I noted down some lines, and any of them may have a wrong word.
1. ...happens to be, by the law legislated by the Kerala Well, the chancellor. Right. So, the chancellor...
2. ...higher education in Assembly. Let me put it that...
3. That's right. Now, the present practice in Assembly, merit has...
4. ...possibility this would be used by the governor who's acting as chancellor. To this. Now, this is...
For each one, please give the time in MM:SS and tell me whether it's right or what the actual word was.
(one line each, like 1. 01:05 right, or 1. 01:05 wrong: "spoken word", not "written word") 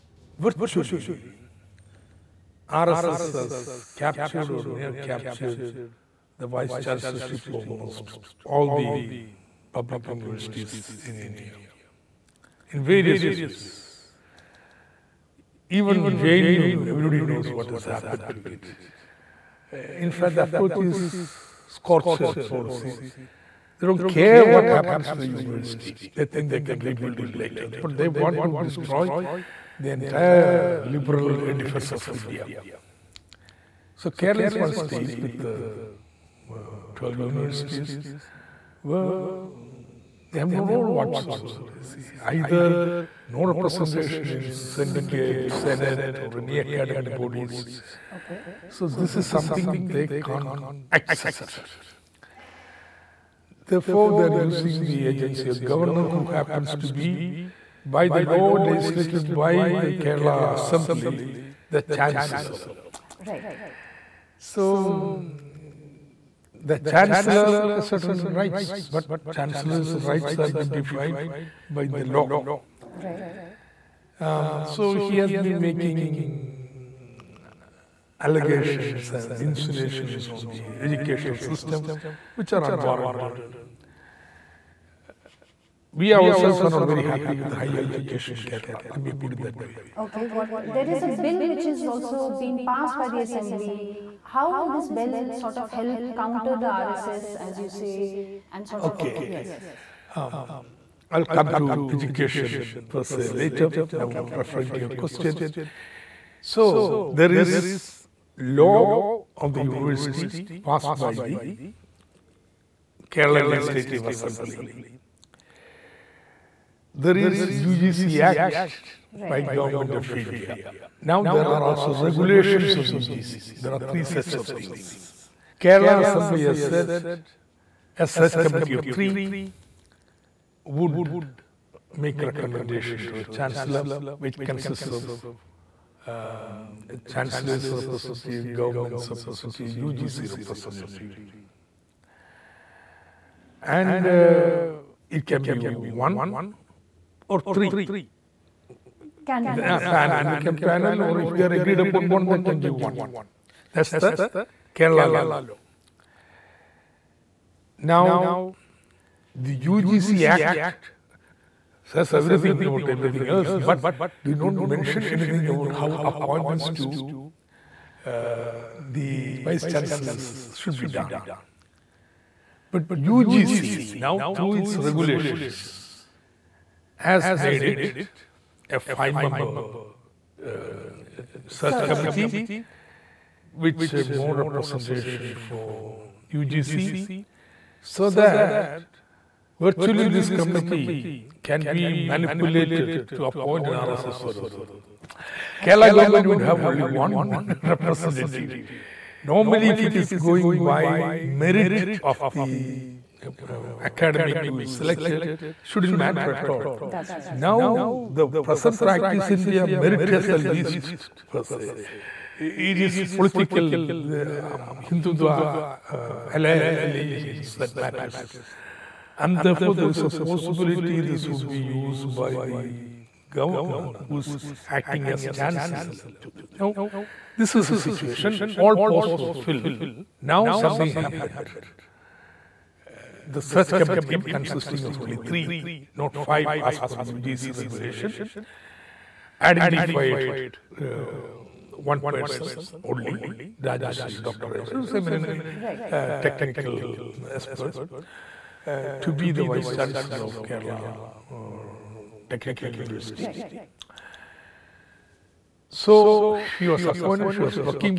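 1. 00:56 wrong: "Assembly", not "Well"
2. 01:27 wrong: "Kerala", not "Assembly"
3. 03:26 wrong: "India", not "Assembly"
4. 03:40 right.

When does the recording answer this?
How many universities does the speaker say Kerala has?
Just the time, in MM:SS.
00:36.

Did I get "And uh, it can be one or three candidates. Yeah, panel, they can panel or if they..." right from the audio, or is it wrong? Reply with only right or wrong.
right.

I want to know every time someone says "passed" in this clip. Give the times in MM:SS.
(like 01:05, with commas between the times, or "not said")
01:32, 01:50.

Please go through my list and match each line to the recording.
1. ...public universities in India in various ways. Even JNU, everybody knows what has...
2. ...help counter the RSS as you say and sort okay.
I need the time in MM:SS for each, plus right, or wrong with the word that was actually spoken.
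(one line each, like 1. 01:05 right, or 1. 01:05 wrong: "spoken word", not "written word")
1. 00:09 right
2. 01:35 right.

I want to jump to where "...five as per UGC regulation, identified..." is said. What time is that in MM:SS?
03:56.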